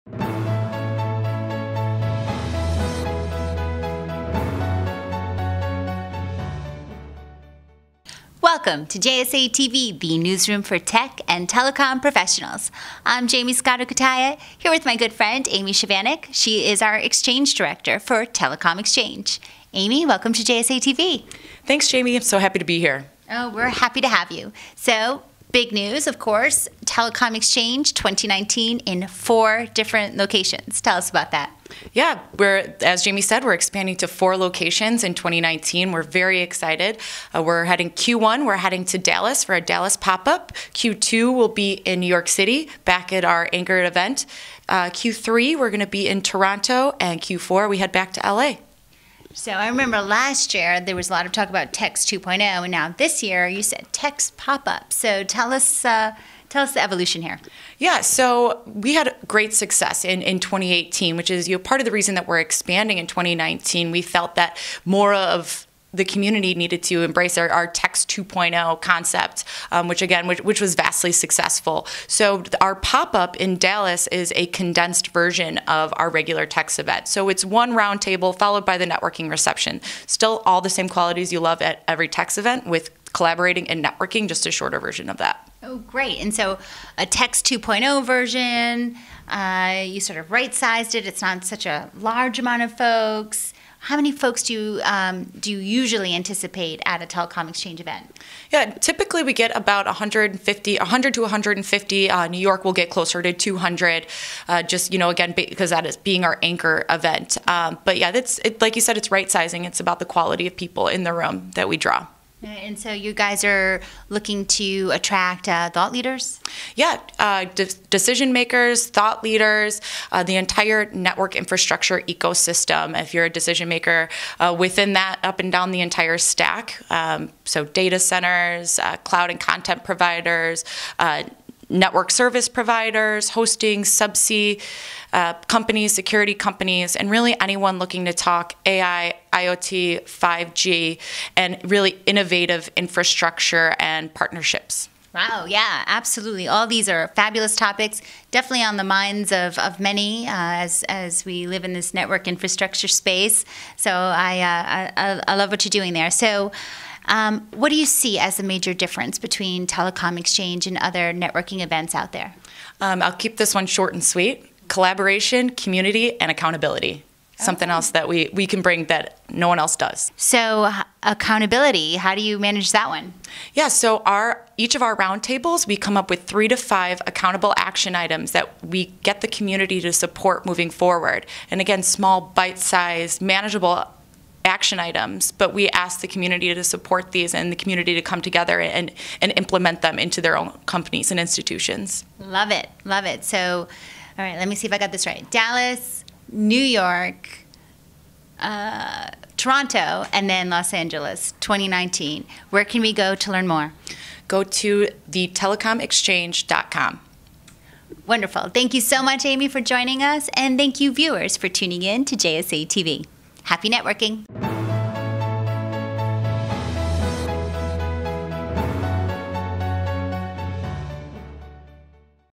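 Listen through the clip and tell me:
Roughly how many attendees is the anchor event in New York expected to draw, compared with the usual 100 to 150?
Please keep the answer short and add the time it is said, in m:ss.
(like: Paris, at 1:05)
200, at 1:43.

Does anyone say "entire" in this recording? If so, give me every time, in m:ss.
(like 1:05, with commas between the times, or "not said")
2:00, 2:05.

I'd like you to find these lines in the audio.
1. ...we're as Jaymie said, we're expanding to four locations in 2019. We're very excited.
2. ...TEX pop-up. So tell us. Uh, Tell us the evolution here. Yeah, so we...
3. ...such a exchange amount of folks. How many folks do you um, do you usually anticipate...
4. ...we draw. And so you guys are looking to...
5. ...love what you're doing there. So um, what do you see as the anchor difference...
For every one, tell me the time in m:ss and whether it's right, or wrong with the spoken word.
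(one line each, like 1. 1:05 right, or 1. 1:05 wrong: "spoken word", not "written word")
1. 0:32 right
2. 0:53 right
3. 1:31 wrong: "large", not "exchange"
4. 1:51 right
5. 2:35 wrong: "major", not "anchor".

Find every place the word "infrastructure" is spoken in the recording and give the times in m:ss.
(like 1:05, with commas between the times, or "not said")
2:01, 2:22, 2:32.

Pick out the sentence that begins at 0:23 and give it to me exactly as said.
Oh, we're happy to have you.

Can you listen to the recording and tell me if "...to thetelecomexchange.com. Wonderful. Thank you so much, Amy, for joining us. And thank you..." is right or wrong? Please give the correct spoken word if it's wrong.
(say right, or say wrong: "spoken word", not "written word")
right.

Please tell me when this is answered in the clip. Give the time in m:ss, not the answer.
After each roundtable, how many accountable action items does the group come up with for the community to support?
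2:56.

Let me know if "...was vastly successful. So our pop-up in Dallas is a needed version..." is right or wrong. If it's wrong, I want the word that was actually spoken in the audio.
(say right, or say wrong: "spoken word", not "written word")
wrong: "condensed", not "needed".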